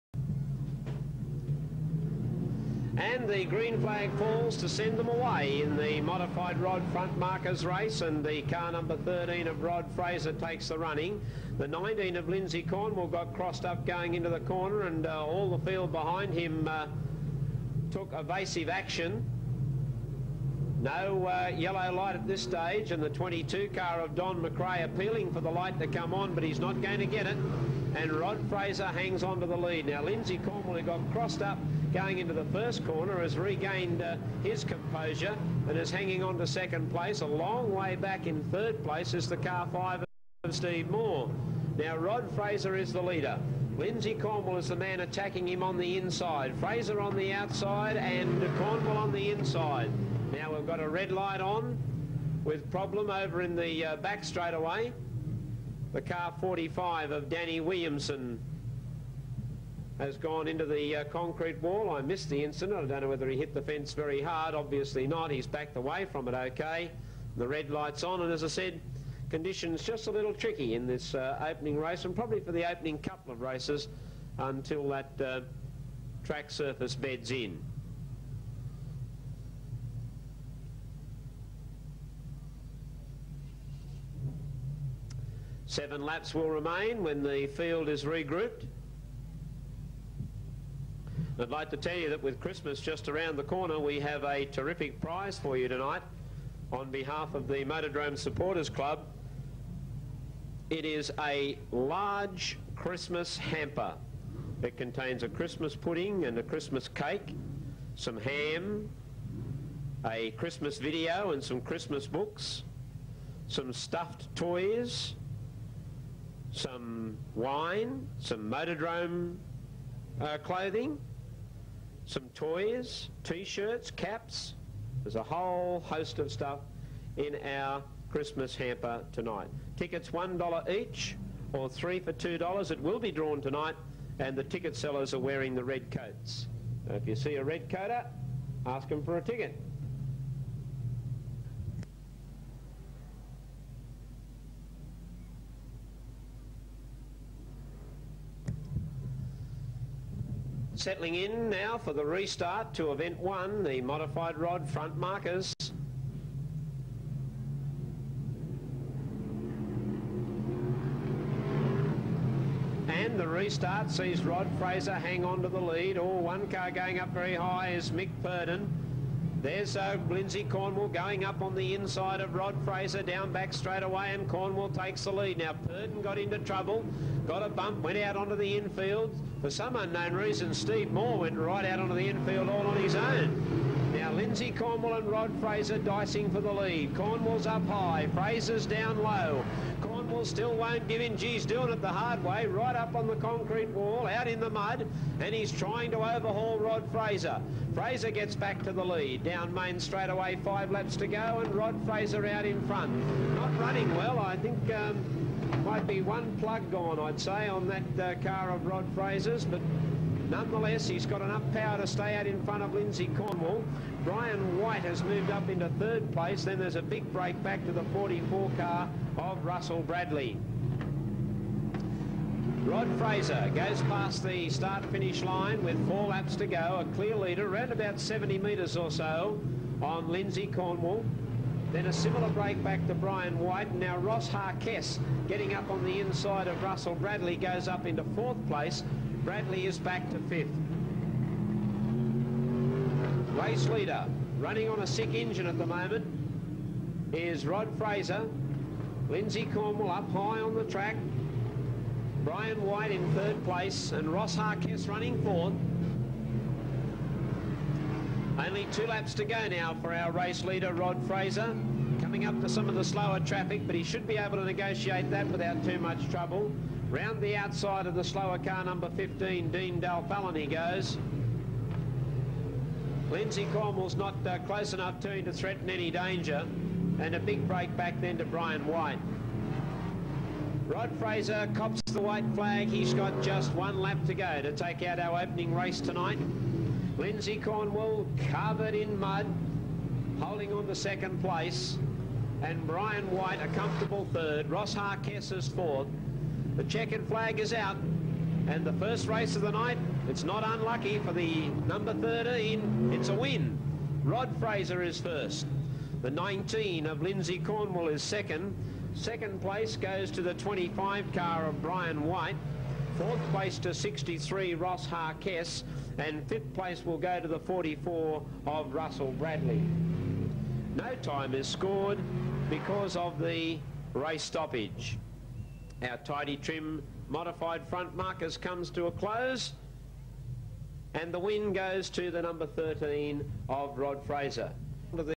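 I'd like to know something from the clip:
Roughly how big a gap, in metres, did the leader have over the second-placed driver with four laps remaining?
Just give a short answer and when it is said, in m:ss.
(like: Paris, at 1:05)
70 metres, at 3:47.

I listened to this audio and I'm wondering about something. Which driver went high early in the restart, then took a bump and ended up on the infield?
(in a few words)
Mick Purden.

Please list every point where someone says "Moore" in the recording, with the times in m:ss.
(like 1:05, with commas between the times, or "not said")
0:40, 3:00.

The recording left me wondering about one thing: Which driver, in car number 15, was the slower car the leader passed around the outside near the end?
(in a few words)
Dean Dalfallan.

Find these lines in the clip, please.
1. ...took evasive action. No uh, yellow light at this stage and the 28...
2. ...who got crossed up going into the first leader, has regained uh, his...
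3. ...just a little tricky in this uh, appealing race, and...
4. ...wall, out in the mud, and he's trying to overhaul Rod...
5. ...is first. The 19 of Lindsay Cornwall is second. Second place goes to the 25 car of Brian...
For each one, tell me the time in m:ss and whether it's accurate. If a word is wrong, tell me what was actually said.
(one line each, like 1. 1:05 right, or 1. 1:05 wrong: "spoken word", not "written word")
1. 0:17 wrong: "22", not "28"
2. 0:30 wrong: "corner", not "leader"
3. 1:09 wrong: "opening", not "appealing"
4. 3:13 right
5. 5:04 right.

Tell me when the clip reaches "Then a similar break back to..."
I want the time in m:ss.
3:51.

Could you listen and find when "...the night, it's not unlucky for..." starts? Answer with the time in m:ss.
4:59.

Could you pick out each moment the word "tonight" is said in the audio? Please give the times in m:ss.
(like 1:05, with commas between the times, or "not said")
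1:35, 2:09, 2:13, 4:45.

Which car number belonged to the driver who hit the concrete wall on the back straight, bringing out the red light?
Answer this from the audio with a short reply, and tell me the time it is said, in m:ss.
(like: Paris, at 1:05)
45, at 0:56.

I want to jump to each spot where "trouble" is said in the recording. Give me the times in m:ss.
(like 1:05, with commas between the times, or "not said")
2:56, 4:26.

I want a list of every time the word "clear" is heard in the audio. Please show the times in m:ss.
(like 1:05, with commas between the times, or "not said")
3:46.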